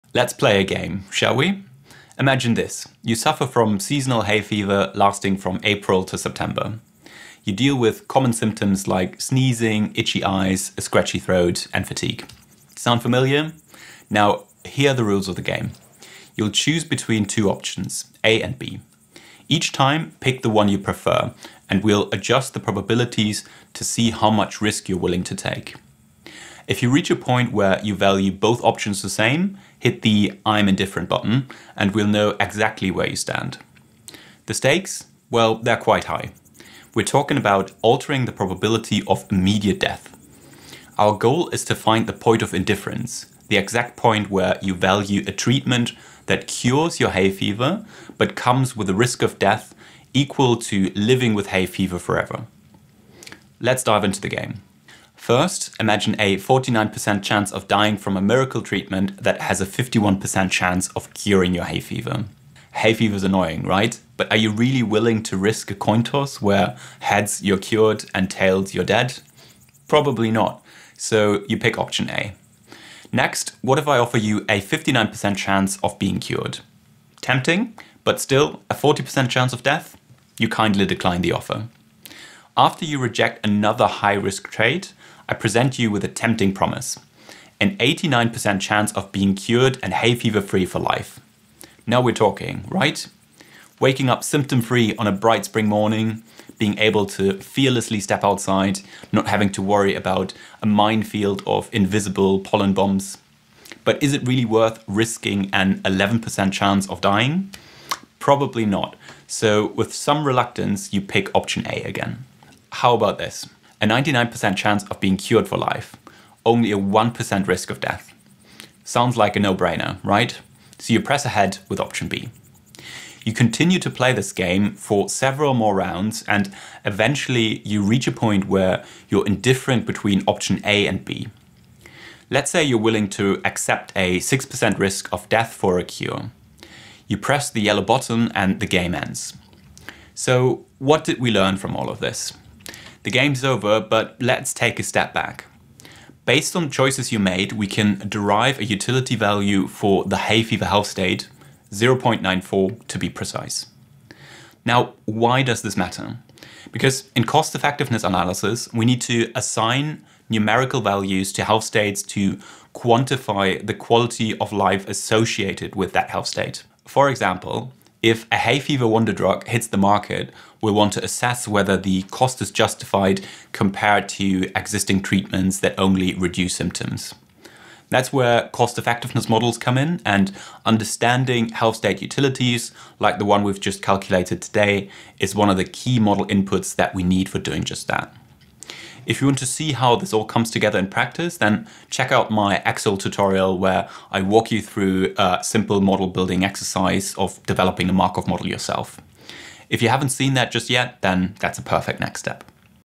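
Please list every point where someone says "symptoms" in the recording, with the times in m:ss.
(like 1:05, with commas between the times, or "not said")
0:08, 1:34, 2:56.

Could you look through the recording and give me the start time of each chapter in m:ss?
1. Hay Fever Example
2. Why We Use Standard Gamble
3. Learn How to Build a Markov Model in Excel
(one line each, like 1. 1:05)
1. 0:53
2. 2:19
3. 3:08.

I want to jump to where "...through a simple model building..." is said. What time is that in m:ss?
3:14.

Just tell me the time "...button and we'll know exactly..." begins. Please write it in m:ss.
0:31.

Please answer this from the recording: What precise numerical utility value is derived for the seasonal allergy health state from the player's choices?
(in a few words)
0.94.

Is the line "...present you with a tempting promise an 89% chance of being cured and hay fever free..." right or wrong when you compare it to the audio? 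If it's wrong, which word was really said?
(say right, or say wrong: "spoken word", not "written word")
right.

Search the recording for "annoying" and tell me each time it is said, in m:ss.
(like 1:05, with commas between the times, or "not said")
1:03.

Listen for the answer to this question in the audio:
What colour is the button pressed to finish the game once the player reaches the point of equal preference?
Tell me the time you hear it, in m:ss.
2:17.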